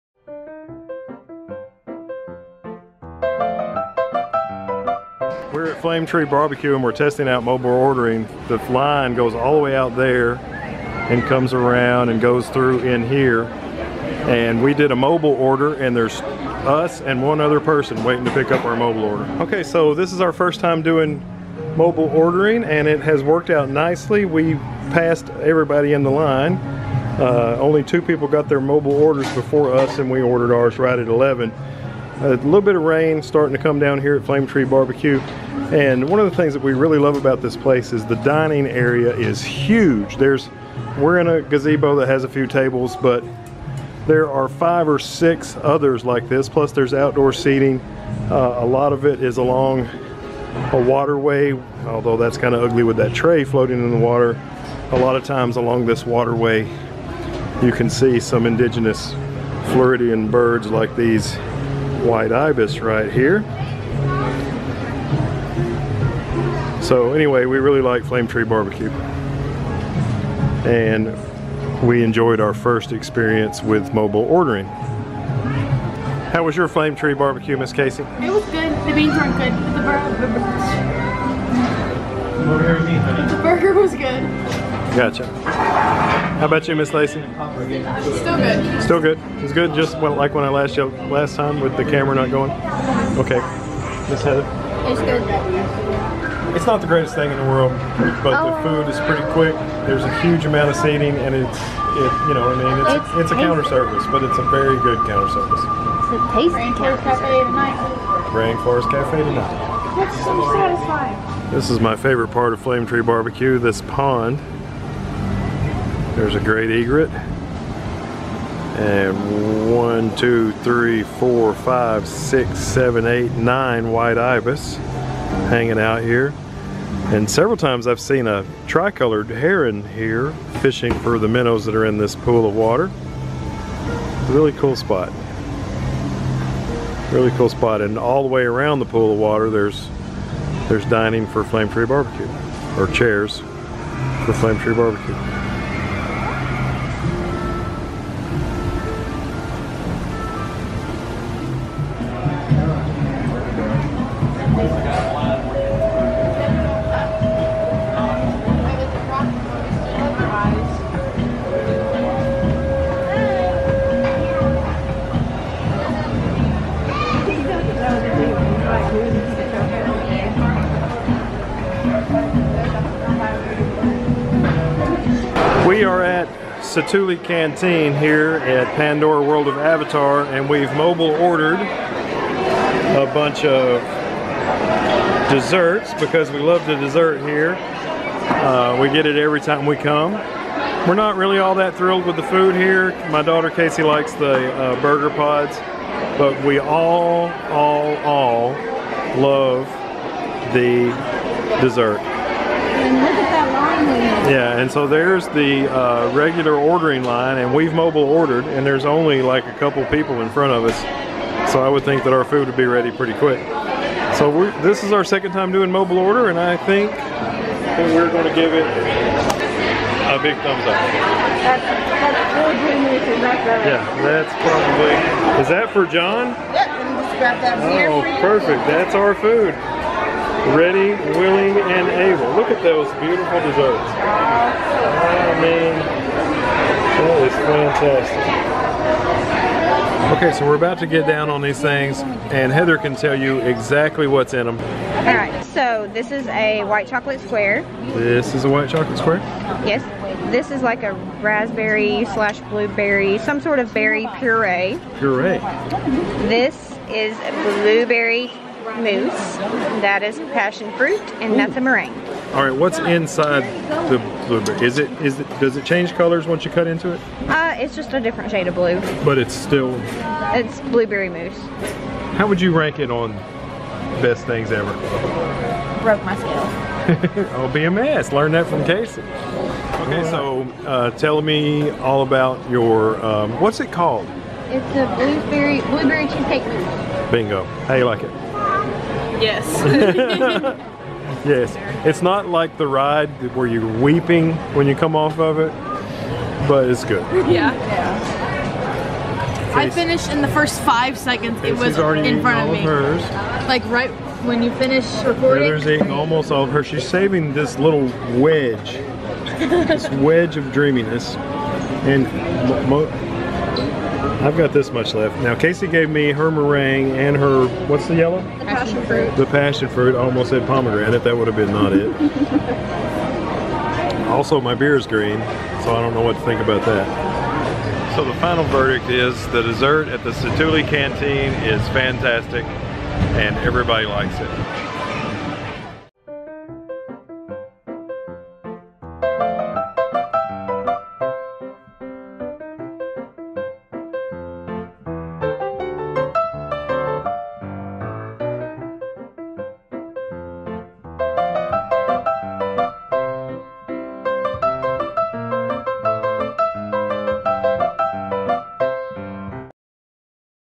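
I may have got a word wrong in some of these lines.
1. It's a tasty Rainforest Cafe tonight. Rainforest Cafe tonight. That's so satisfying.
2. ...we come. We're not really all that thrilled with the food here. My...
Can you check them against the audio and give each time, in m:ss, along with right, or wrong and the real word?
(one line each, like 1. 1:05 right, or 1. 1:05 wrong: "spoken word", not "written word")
1. 1:45 right
2. 3:09 right.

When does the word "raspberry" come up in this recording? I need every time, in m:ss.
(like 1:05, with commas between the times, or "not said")
4:11.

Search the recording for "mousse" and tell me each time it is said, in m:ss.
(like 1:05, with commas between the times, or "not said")
4:18, 4:31, 4:46.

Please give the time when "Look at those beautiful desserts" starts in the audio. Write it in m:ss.
3:52.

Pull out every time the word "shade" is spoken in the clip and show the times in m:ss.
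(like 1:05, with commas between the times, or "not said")
4:28.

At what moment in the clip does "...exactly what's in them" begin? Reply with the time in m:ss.
4:03.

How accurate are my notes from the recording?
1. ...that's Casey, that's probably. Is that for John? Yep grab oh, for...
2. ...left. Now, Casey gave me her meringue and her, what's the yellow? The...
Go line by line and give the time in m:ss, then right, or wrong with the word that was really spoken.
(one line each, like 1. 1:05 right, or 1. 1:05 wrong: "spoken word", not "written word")
1. 3:43 wrong: "Yeah", not "Casey"
2. 5:14 right.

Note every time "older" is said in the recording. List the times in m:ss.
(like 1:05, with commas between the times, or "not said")
not said.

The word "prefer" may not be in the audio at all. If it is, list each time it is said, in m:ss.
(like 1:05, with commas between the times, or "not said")
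not said.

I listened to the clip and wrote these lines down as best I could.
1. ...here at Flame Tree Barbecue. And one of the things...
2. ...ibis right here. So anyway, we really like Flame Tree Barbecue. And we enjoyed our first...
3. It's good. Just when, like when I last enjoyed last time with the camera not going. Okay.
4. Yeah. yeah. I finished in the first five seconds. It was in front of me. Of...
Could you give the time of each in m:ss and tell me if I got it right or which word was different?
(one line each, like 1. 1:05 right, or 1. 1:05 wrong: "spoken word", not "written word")
1. 0:33 right
2. 1:02 right
3. 1:29 wrong: "yelled", not "enjoyed"
4. 4:57 right.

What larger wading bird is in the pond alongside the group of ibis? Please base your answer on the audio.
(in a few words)
Great egret.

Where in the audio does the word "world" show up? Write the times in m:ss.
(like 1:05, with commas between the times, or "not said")
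1:37, 2:59.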